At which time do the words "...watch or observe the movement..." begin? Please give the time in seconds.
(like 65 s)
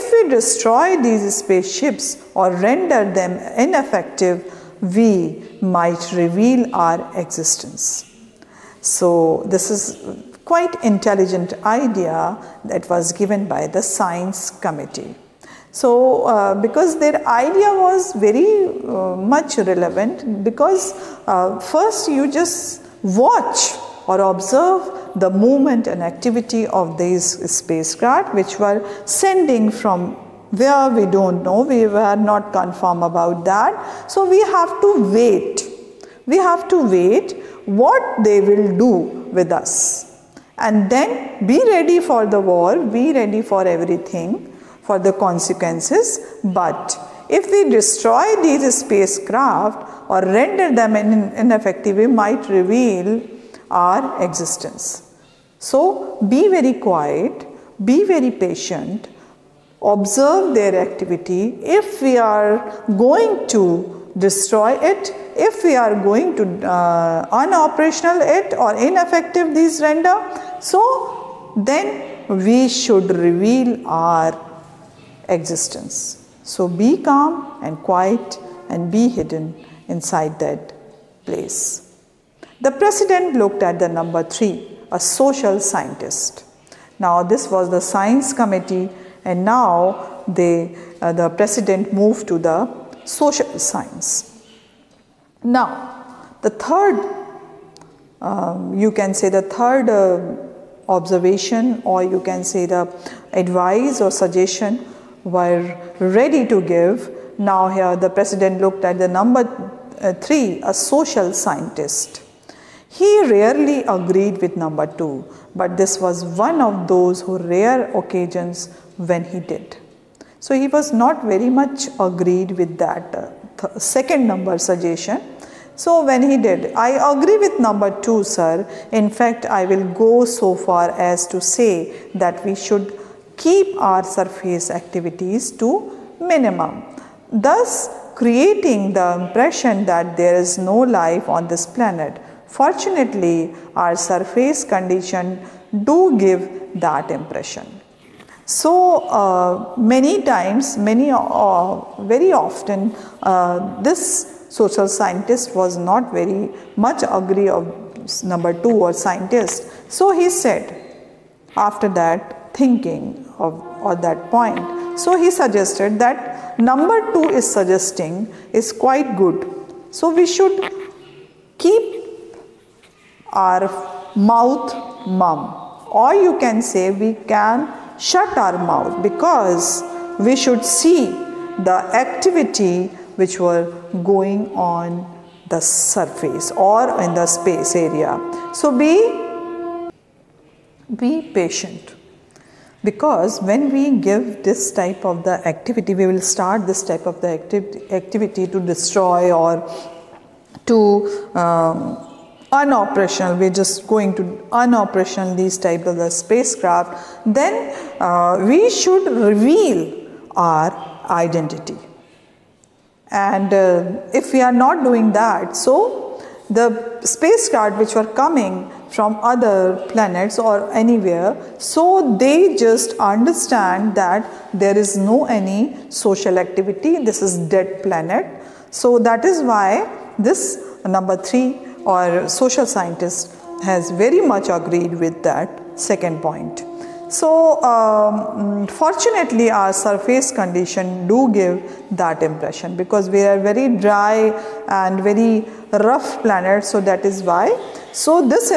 23 s.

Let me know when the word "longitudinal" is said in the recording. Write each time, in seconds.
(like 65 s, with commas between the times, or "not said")
not said.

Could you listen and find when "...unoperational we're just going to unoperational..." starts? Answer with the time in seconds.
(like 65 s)
202 s.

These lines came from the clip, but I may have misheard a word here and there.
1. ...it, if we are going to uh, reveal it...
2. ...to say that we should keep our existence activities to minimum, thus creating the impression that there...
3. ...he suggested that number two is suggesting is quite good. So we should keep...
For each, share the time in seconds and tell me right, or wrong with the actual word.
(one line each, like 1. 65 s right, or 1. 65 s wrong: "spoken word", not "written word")
1. 64 s wrong: "unoperational", not "reveal"
2. 131 s wrong: "surface", not "existence"
3. 165 s right.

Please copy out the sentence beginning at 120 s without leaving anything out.
So, he was not very much agreed with that uh, second number suggestion.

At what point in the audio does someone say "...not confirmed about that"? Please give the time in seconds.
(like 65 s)
32 s.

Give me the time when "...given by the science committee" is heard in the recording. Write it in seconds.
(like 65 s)
13 s.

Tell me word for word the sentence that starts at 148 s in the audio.
So uh, many times, many uh, very often, uh, this social scientist was not very much agree of number two or scientist.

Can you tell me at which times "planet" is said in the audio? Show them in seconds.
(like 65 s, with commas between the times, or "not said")
141 s, 219 s, 227 s, 246 s.